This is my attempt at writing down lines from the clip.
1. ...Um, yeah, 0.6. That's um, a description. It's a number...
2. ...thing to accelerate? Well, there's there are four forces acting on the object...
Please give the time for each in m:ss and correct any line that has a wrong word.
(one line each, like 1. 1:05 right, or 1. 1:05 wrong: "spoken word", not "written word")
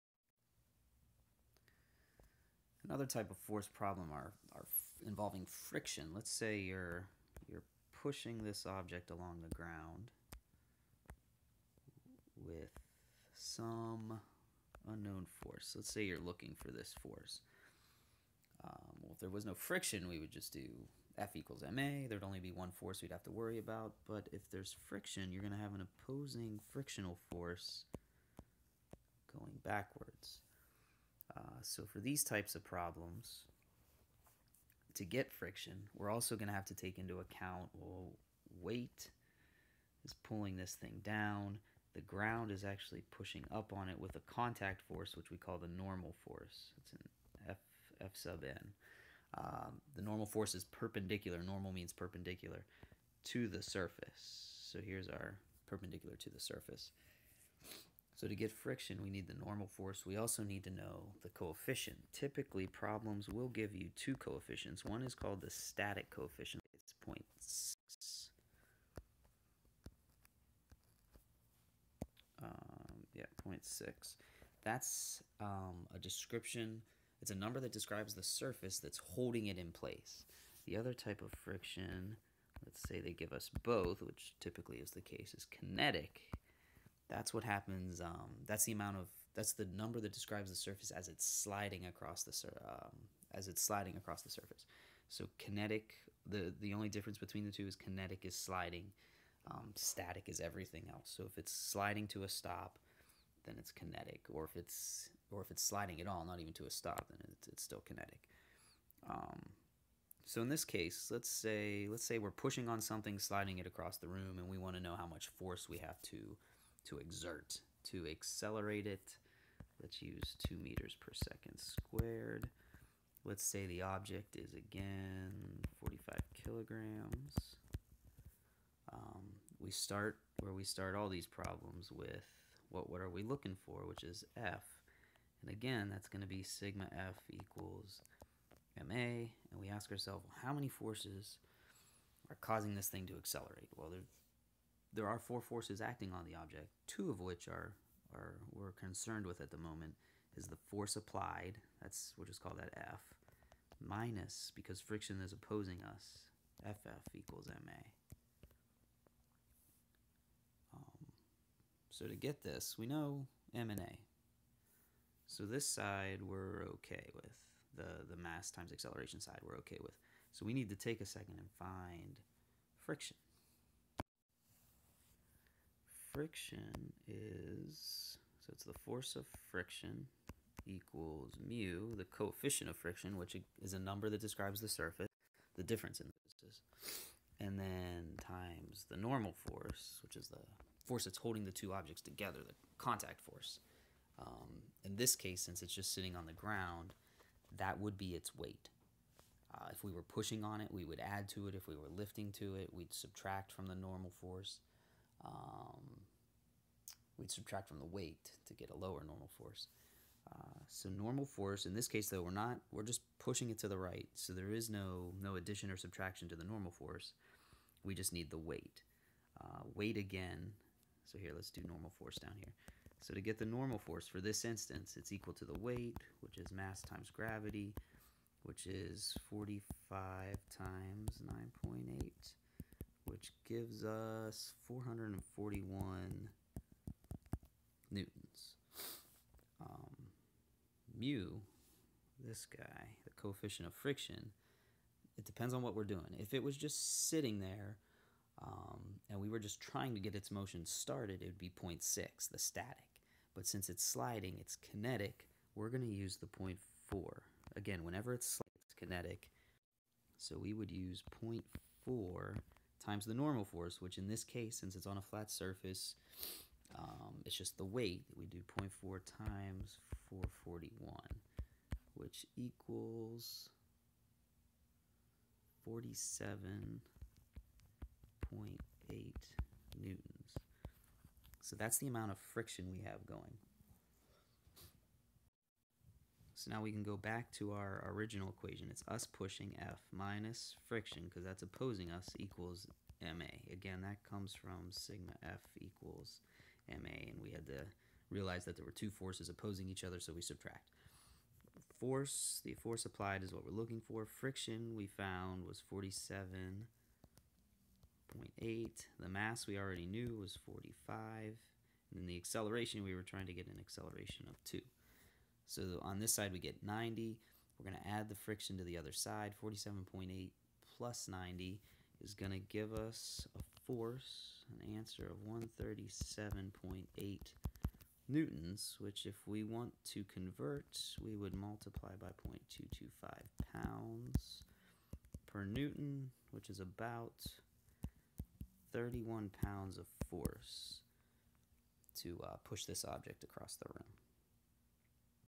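1. 1:12 right
2. 2:22 right.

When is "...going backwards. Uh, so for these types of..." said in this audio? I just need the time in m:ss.
0:29.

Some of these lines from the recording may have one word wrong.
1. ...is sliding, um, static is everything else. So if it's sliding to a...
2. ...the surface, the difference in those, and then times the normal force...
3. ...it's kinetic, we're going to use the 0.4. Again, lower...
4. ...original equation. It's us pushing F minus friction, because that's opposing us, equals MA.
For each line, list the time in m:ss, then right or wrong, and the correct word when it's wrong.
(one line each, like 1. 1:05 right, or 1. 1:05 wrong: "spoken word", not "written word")
1. 1:38 right
2. 3:04 right
3. 4:14 wrong: "whenever", not "lower"
4. 4:47 right.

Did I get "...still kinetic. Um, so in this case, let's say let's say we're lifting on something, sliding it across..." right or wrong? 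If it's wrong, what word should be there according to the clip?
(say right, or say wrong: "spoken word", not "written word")
wrong: "pushing", not "lifting".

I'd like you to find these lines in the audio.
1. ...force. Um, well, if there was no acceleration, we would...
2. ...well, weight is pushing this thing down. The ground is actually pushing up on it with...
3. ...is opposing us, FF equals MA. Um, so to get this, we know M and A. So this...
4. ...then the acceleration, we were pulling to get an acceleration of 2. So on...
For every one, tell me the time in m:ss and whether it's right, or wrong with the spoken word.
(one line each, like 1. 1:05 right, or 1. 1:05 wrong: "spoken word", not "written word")
1. 0:17 wrong: "friction", not "acceleration"
2. 0:37 wrong: "pulling", not "pushing"
3. 2:35 right
4. 5:11 wrong: "trying", not "pulling".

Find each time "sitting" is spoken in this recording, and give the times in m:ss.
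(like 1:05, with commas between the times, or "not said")
3:15, 4:07.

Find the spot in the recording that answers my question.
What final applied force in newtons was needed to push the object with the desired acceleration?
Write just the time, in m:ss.
5:25.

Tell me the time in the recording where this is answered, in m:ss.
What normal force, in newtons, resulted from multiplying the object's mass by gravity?
3:54.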